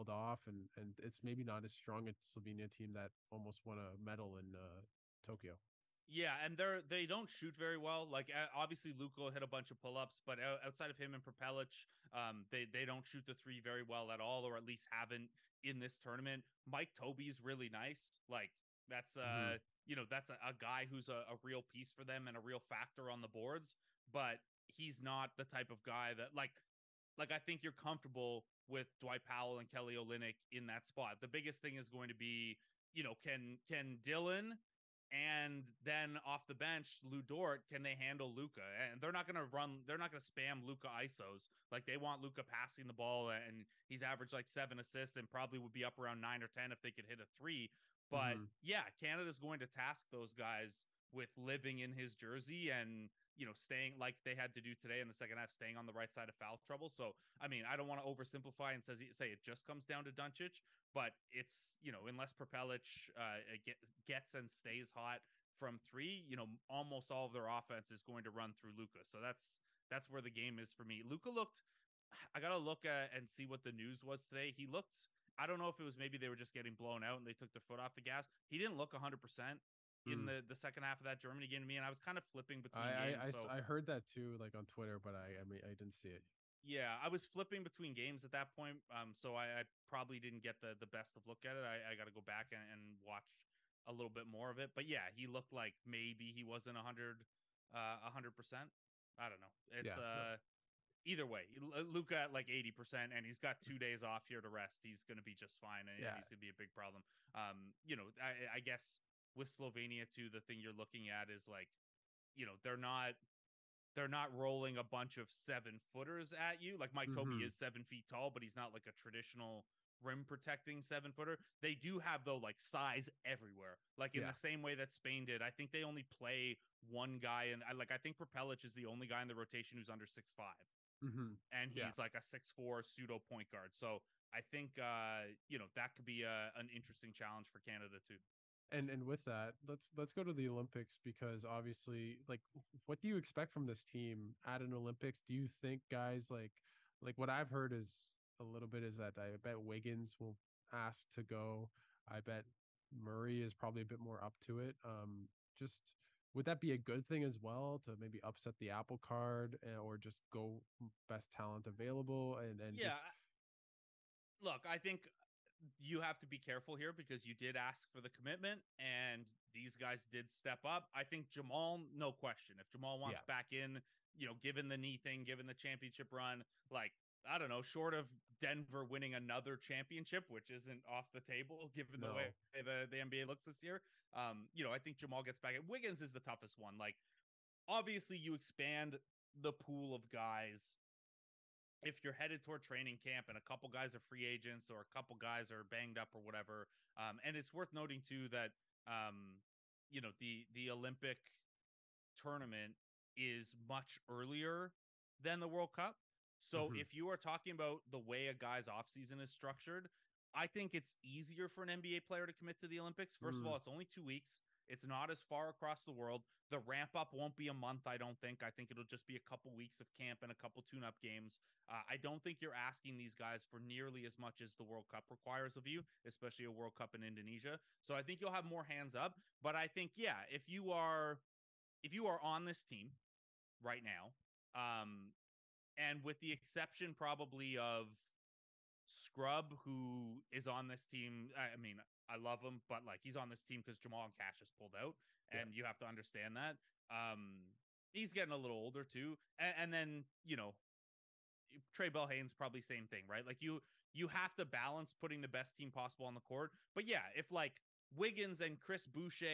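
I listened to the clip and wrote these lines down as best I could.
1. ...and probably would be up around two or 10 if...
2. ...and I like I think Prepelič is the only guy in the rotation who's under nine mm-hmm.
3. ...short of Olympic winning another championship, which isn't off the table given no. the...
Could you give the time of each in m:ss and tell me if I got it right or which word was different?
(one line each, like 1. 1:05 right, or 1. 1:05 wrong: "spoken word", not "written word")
1. 0:45 wrong: "nine", not "two"
2. 2:07 wrong: "six", not "nine"
3. 2:57 wrong: "Denver", not "Olympic".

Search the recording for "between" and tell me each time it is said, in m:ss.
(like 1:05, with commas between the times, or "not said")
1:22, 1:27.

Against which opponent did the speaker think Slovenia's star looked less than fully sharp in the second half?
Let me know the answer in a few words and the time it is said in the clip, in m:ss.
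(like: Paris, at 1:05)
Germany, at 1:21.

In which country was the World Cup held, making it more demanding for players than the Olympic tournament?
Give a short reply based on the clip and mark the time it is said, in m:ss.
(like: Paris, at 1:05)
Indonesia, at 3:47.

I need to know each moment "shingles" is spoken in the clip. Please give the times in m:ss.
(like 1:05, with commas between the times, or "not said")
not said.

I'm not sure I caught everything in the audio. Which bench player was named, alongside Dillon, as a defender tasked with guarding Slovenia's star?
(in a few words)
Lu Dort.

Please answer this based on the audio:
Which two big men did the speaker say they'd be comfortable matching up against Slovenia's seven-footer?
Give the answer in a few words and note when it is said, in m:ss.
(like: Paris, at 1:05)
Dwight Powell and Kelly Olynyk, at 0:28.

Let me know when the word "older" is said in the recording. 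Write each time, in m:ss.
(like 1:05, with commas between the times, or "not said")
4:08.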